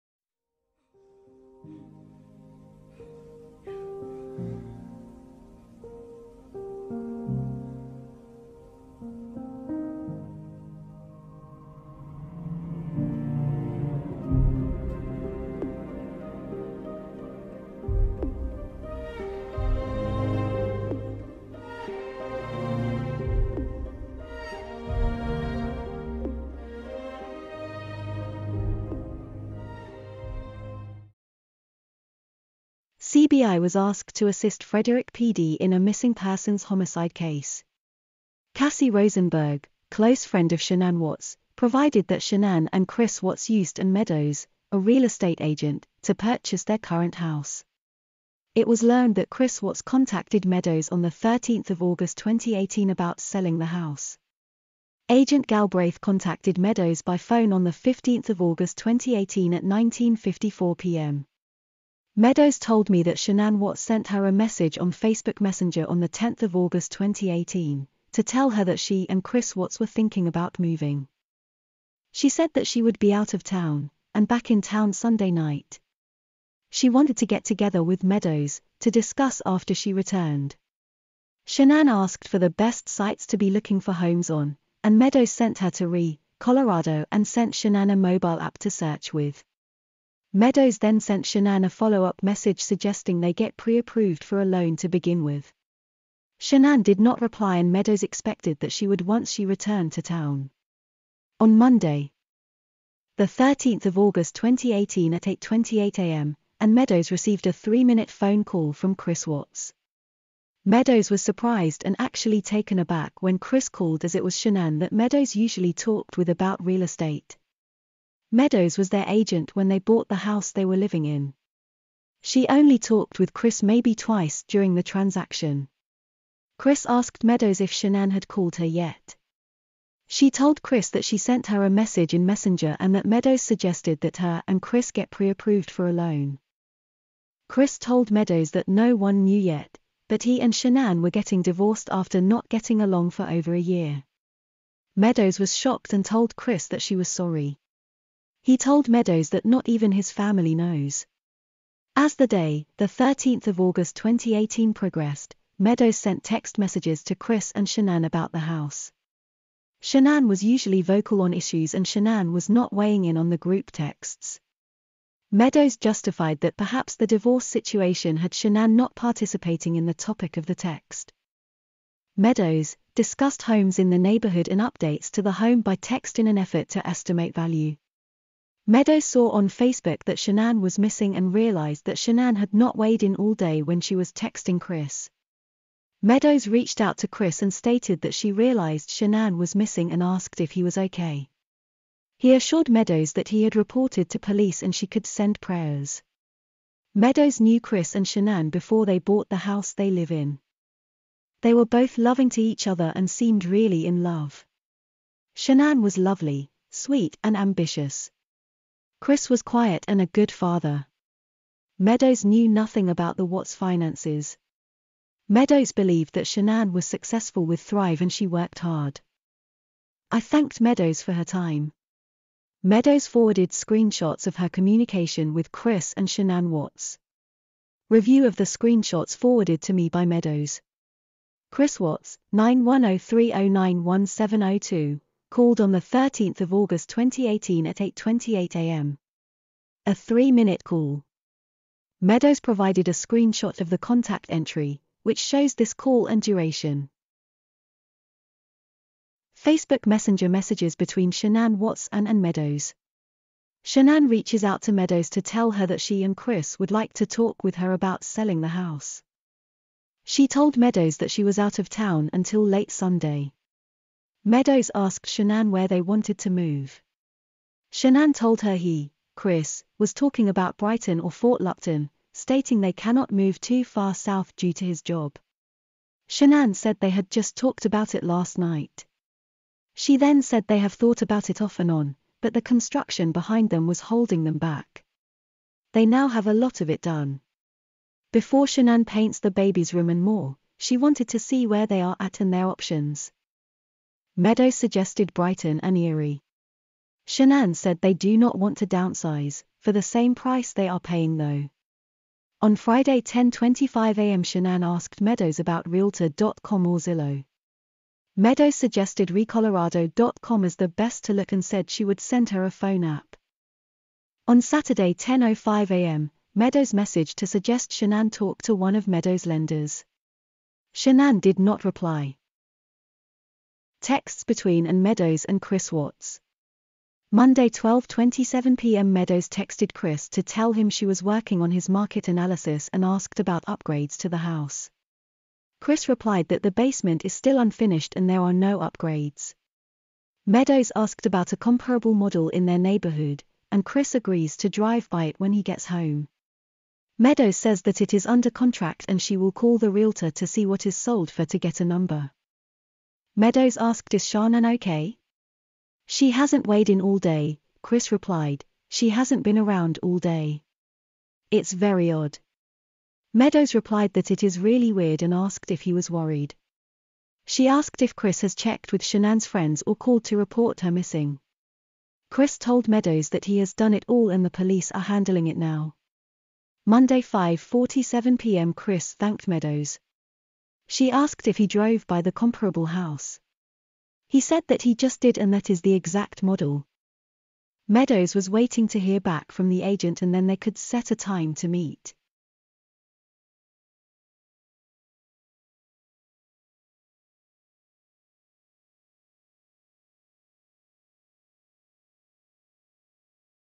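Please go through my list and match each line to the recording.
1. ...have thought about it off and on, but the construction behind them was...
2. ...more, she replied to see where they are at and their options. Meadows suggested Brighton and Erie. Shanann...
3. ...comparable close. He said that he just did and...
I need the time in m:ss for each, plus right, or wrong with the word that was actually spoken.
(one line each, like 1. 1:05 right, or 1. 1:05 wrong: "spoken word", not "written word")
1. 4:40 right
2. 4:50 wrong: "wanted", not "replied"
3. 6:22 wrong: "house", not "close".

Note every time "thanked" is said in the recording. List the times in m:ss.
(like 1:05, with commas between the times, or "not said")
3:40, 6:18.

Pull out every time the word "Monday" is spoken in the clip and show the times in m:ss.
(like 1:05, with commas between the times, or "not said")
1:41, 5:27, 6:16.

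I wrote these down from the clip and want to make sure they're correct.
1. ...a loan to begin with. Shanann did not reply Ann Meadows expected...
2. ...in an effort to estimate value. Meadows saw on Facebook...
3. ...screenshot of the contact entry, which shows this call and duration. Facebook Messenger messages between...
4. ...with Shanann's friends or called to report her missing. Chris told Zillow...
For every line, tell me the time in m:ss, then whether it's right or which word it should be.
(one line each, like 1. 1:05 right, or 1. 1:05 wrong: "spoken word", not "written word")
1. 1:34 right
2. 2:56 right
3. 4:02 right
4. 6:08 wrong: "Meadows", not "Zillow".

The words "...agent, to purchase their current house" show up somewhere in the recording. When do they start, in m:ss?
0:45.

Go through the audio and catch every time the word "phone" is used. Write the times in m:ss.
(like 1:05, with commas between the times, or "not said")
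0:57, 1:48, 5:12.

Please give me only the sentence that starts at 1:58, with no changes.
Meadows was their agent when they bought the house they were living in.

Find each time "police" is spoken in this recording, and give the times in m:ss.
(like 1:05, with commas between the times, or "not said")
3:14, 6:14.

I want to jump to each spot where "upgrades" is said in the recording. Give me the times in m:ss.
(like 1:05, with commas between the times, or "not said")
5:33, 5:38.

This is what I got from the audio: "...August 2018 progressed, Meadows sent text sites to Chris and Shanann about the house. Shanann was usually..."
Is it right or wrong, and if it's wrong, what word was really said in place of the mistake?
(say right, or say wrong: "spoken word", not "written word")
wrong: "messages", not "sites".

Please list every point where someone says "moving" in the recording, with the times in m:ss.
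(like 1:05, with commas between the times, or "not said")
1:10.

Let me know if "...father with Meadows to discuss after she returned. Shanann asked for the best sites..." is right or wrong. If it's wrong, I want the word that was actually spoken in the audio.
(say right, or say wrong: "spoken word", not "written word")
wrong: "together", not "father".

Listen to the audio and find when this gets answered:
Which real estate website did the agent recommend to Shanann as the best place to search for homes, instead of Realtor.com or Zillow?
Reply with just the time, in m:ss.
5:09.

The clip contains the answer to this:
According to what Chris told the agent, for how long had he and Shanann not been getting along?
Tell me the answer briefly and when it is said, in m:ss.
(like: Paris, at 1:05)
over a year, at 2:23.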